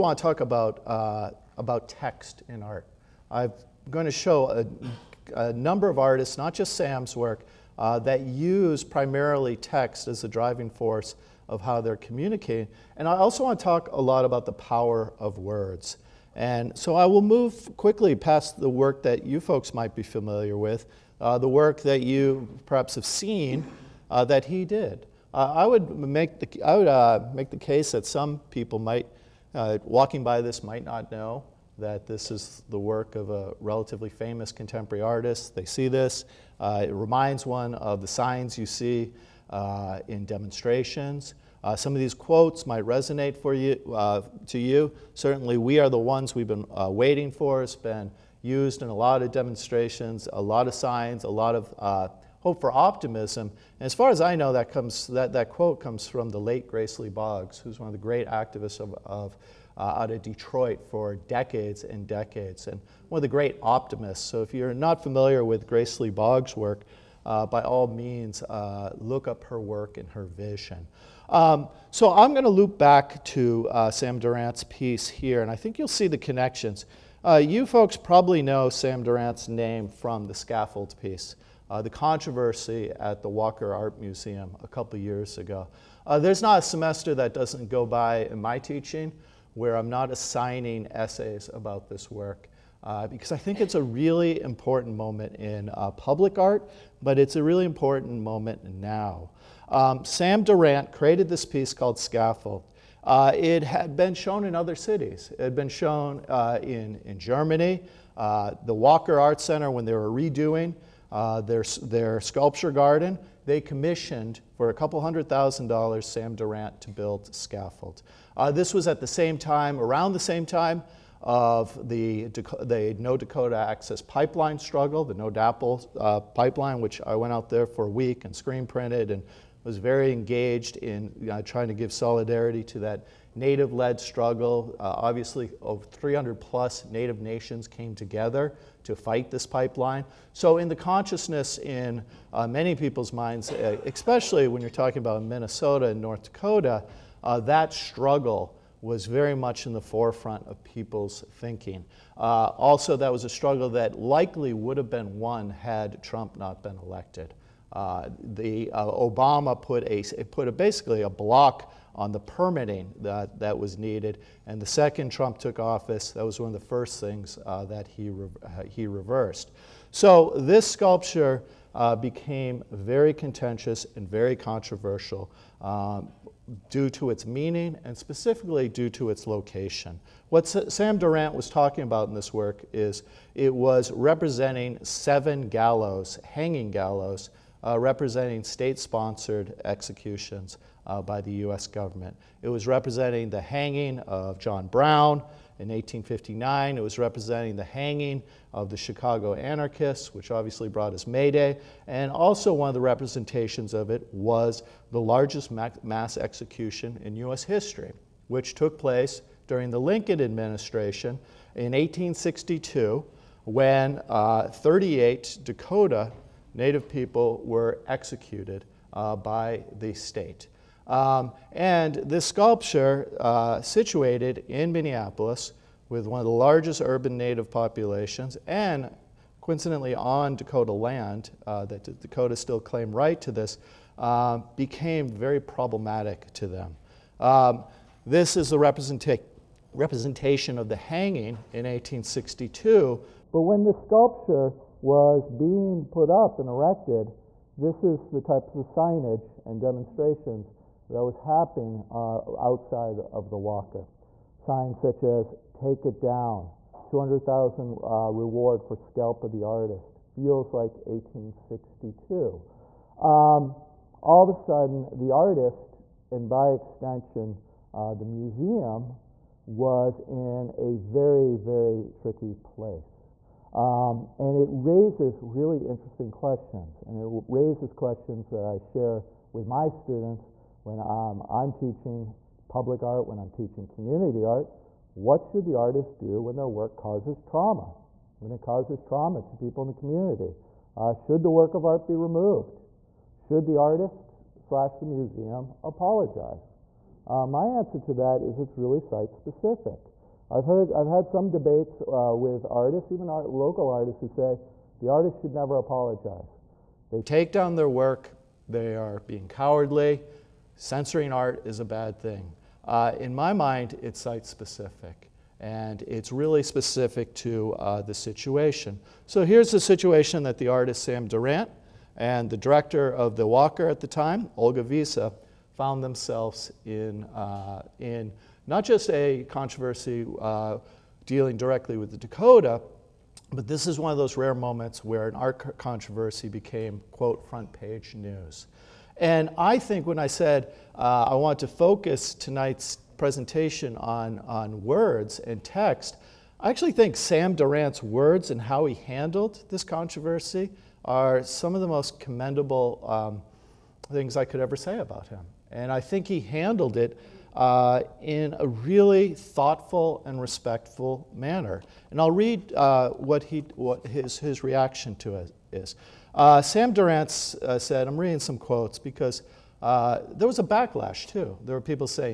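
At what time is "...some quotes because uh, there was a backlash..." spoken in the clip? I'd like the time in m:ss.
6:08.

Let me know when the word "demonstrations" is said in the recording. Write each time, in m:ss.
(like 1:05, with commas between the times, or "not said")
0:40, 0:49, 4:09.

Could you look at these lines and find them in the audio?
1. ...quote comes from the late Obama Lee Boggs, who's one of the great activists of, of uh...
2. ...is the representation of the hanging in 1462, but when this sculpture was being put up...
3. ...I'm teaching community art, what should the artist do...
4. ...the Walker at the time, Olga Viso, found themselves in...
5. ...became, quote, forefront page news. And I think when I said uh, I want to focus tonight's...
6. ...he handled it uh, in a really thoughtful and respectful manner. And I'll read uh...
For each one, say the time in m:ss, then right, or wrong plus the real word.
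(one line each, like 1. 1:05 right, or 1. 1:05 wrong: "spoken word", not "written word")
1. 0:55 wrong: "Grace", not "Obama"
2. 3:58 wrong: "1862", not "1462"
3. 4:43 right
4. 5:23 right
5. 5:36 wrong: "front", not "forefront"
6. 5:56 right.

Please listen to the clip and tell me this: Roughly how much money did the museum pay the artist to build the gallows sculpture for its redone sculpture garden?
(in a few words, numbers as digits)
a couple hundred thousand dollars.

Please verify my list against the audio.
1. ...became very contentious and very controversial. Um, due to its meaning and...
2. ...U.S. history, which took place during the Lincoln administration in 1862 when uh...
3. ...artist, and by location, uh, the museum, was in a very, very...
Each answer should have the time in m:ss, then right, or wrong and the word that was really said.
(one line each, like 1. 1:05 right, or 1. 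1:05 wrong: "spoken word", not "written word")
1. 2:51 right
2. 3:27 right
3. 4:25 wrong: "extension", not "location".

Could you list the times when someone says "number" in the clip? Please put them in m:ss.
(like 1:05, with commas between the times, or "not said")
0:05.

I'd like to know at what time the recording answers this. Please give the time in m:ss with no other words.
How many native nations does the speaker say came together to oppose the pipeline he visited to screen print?
2:15.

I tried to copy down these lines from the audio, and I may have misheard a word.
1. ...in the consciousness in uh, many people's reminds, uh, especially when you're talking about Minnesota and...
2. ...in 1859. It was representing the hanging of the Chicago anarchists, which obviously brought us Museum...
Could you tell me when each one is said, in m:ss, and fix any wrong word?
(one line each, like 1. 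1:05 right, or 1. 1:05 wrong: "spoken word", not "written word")
1. 2:20 wrong: "minds", not "reminds"
2. 3:15 wrong: "May", not "Museum".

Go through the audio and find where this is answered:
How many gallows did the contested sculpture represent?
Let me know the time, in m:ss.
3:04.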